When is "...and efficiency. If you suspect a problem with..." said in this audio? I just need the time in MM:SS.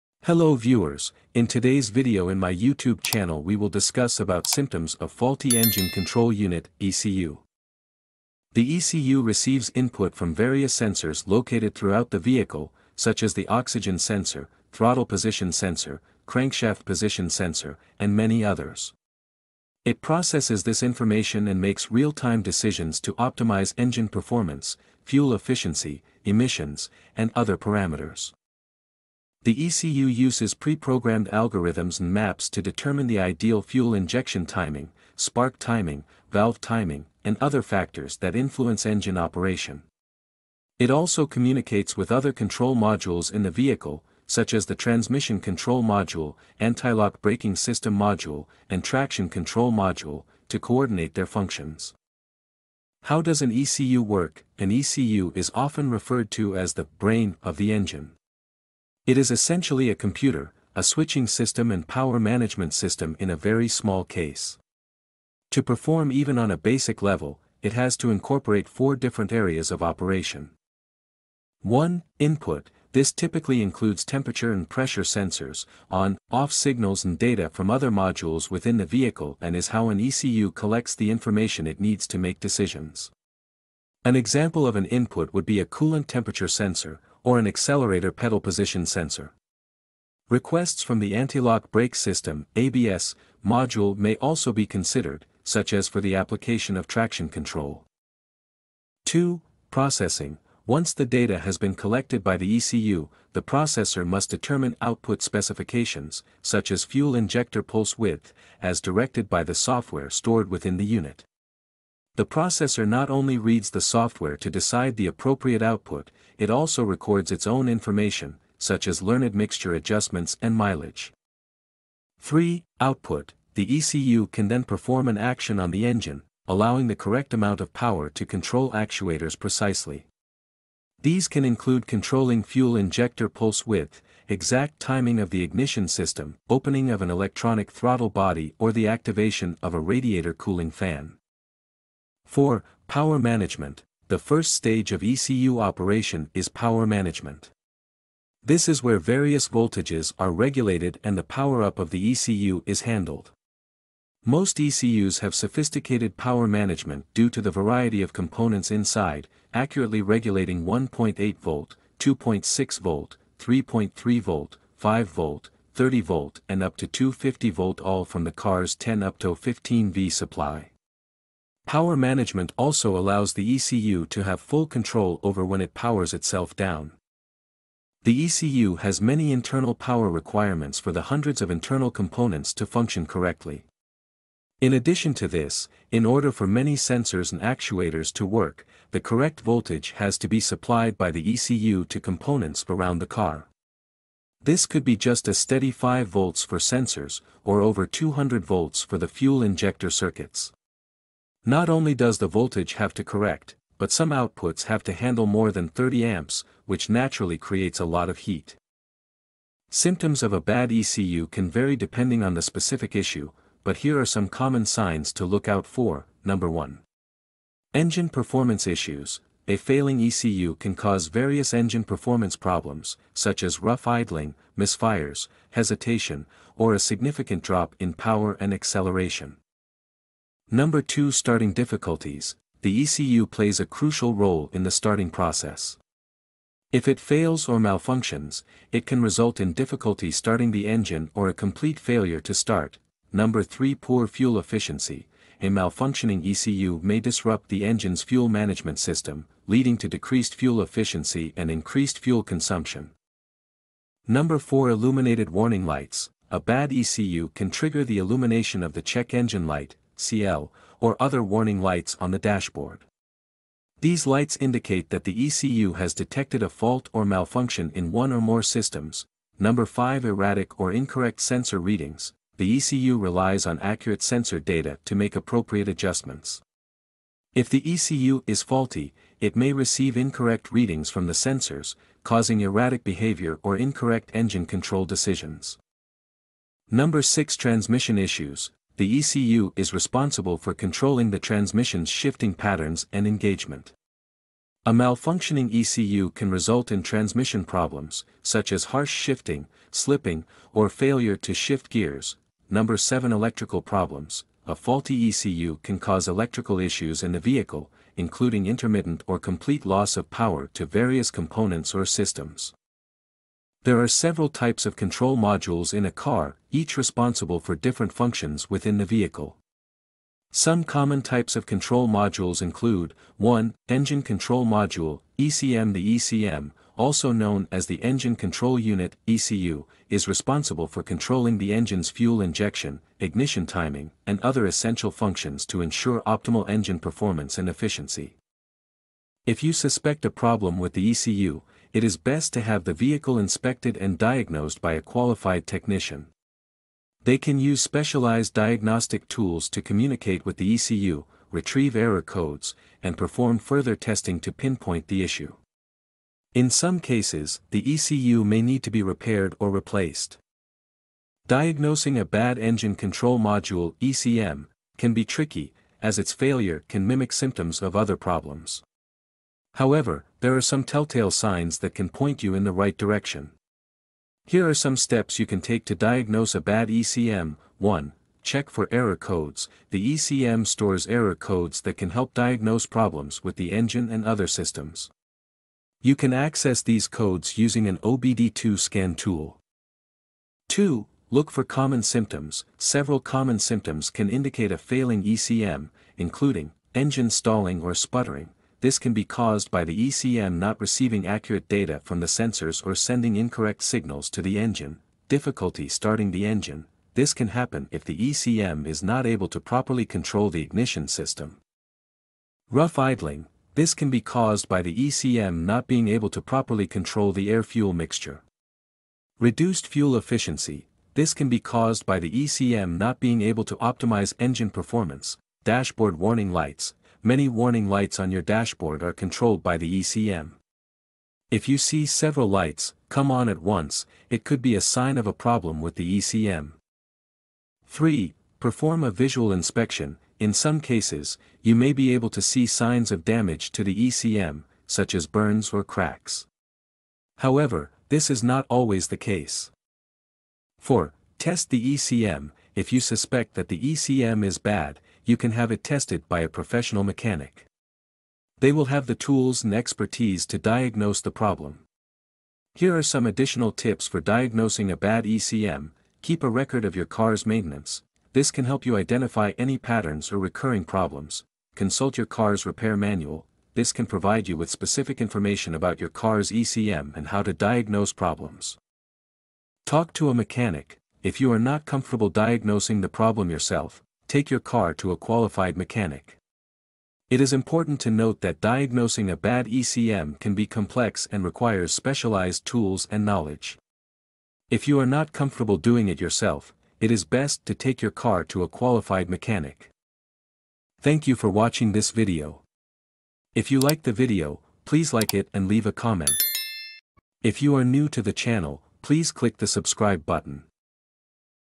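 05:37.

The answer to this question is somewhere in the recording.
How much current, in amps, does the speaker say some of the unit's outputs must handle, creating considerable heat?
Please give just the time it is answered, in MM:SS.
03:25.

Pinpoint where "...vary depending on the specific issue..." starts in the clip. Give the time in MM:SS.
03:31.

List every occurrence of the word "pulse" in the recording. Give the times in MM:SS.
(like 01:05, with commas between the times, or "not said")
01:47, 02:13.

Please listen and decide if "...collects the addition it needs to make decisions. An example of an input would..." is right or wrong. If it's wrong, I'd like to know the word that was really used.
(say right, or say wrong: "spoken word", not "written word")
wrong: "information", not "addition".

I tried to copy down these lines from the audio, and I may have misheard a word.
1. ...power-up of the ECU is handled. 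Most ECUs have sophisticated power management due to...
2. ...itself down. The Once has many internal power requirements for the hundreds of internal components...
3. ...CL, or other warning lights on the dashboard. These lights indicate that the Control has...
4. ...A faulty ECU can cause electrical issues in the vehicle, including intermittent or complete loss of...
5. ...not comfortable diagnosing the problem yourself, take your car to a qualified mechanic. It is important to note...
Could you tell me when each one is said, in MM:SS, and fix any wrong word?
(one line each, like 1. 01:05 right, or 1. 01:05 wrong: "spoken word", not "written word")
1. 02:31 right
2. 02:56 wrong: "ECU", not "Once"
3. 04:20 wrong: "ECU", not "Control"
4. 05:04 right
5. 08:01 right.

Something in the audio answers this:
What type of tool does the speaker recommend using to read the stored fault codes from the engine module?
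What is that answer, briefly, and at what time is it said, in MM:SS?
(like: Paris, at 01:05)
OBD2 scan tool, at 06:27.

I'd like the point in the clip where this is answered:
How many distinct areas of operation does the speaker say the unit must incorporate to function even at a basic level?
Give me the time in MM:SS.
01:08.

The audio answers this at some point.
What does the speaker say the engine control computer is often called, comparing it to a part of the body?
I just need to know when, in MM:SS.
00:56.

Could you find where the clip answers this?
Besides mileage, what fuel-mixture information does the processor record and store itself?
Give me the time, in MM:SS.
01:59.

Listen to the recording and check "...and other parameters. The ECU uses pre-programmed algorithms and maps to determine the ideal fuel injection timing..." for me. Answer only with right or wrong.
right.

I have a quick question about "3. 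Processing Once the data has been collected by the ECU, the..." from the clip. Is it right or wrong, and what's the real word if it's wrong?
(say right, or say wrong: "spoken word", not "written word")
wrong: "2", not "3".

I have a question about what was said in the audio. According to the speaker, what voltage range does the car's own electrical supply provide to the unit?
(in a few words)
10 to 15 V.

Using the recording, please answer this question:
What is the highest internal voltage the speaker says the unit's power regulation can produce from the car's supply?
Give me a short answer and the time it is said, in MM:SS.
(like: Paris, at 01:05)
250 volts, at 02:46.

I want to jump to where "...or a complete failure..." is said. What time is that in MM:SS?
04:01.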